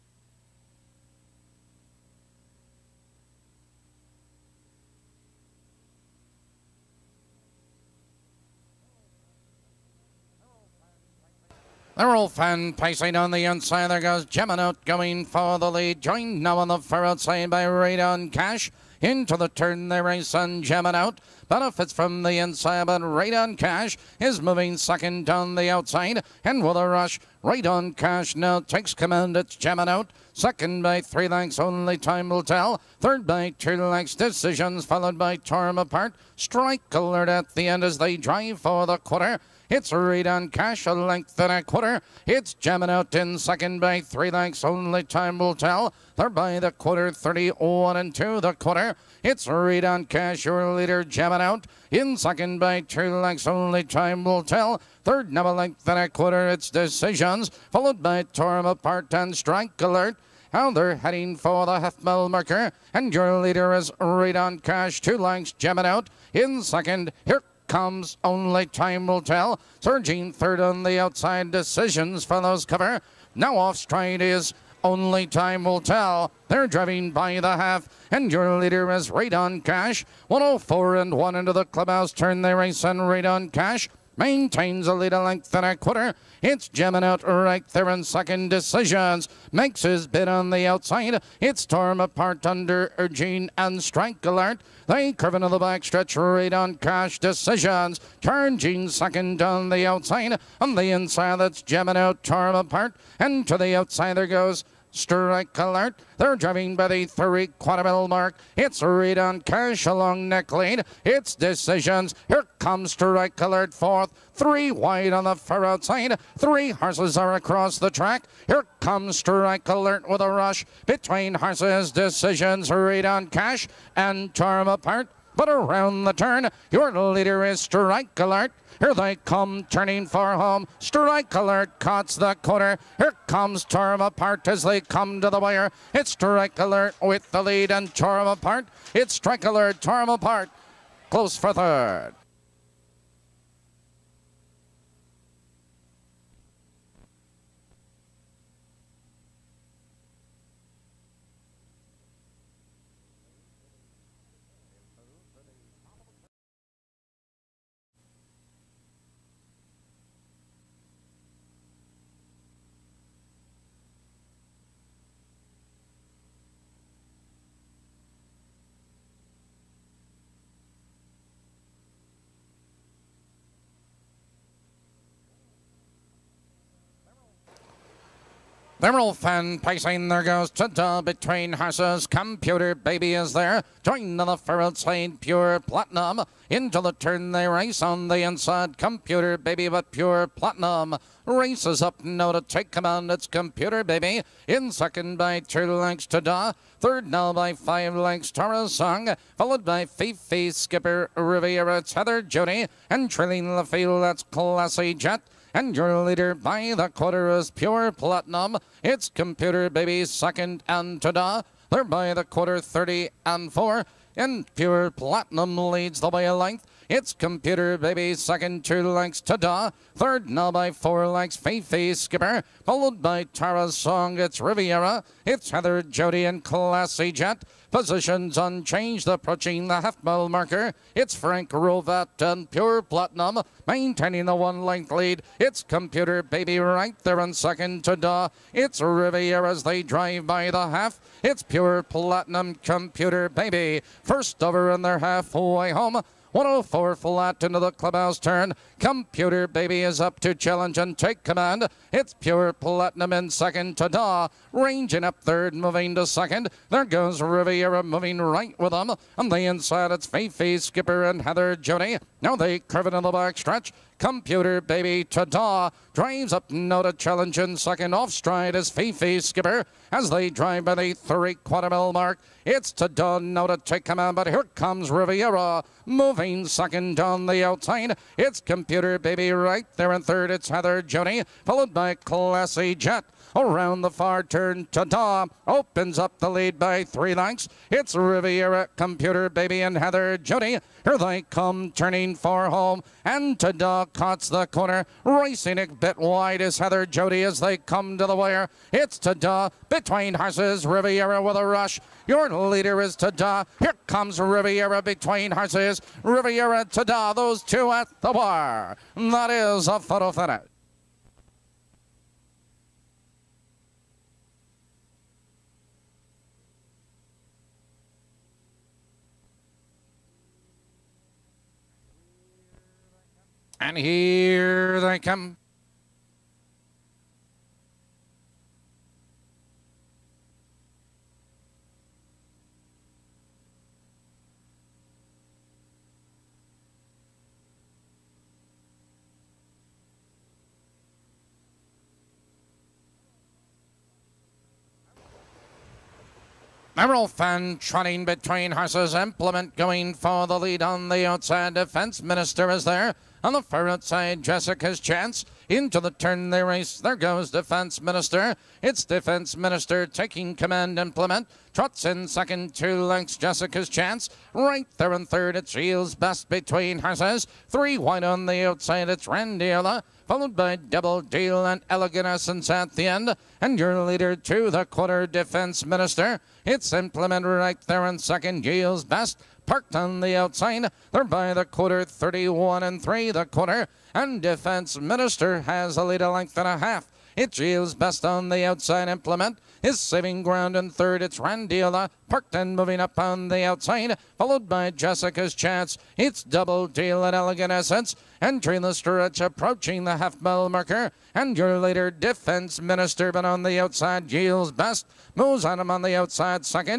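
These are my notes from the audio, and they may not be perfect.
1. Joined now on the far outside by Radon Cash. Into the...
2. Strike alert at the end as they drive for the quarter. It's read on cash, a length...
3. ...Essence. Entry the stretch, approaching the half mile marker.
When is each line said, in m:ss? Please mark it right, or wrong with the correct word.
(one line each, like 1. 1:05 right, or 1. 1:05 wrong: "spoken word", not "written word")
1. 0:16 right
2. 0:36 right
3. 6:37 right.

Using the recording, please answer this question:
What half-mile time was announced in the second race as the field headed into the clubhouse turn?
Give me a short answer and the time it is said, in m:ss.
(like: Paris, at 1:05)
1:04 flat, at 4:06.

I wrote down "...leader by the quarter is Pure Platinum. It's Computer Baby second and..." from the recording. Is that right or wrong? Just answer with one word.
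right.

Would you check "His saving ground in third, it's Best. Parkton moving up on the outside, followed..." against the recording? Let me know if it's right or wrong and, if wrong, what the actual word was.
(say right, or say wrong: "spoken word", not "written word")
wrong: "Randiola", not "Best".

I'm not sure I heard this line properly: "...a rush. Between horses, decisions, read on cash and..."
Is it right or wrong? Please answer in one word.
right.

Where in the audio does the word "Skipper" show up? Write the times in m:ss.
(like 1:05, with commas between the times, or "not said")
3:20, 3:41, 4:20, 4:29.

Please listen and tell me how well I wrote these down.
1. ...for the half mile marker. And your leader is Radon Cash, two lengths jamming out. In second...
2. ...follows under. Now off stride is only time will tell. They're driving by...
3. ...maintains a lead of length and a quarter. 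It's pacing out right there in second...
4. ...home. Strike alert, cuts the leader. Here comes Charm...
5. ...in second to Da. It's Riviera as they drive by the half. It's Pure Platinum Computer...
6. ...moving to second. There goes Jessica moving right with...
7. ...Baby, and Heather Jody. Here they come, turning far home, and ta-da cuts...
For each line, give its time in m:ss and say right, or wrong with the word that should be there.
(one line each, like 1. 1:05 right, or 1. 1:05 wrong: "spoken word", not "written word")
1. 1:01 right
2. 1:12 wrong: "cover", not "under"
3. 1:24 wrong: "jamming", not "pacing"
4. 2:10 wrong: "corner", not "leader"
5. 3:57 right
6. 4:15 wrong: "Riviera", not "Jessica"
7. 4:49 right.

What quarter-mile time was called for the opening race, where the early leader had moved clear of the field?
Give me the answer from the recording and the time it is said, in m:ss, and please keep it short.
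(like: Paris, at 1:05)
31 and 2, at 0:47.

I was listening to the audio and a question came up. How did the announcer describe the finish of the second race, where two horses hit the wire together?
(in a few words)
Photo finish.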